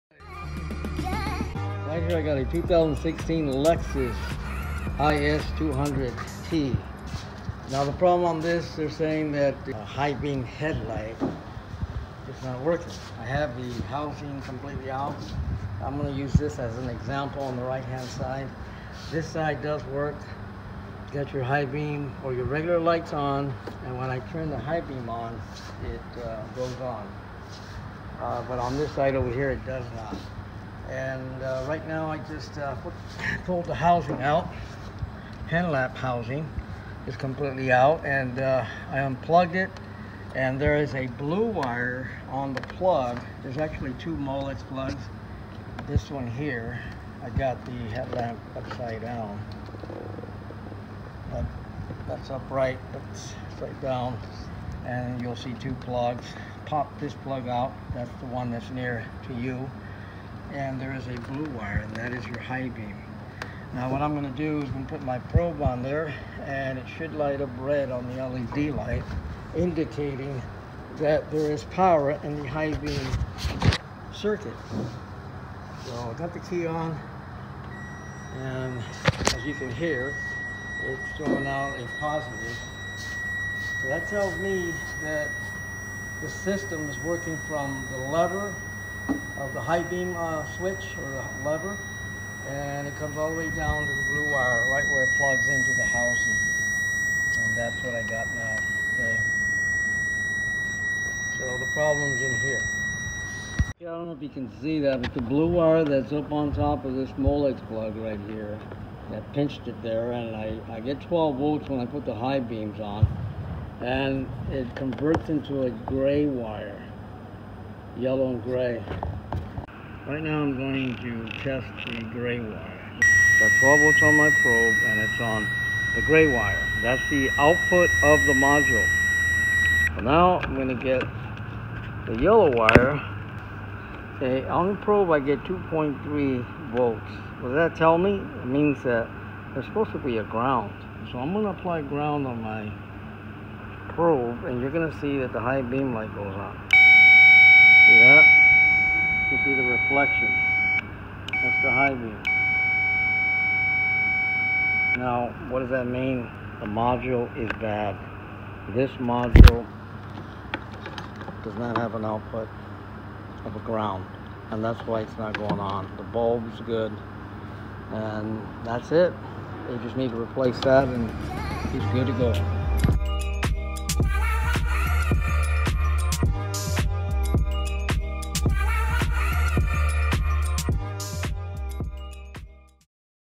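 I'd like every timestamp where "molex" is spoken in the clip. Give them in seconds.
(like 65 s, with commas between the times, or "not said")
44 s, 107 s.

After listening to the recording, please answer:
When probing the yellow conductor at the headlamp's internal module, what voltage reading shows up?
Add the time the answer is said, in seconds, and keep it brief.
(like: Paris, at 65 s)
2.3 volts, at 135 s.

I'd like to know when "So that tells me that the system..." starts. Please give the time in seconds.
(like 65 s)
83 s.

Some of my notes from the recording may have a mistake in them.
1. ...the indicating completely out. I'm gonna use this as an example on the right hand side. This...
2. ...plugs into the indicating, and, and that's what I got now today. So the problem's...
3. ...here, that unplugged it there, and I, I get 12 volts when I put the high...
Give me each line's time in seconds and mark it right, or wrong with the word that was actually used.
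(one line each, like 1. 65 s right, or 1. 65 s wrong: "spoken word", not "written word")
1. 13 s wrong: "housing", not "indicating"
2. 95 s wrong: "housing", not "indicating"
3. 108 s wrong: "pinched", not "unplugged".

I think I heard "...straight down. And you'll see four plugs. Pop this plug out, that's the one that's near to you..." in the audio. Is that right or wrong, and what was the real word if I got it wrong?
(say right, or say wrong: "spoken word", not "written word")
wrong: "two", not "four".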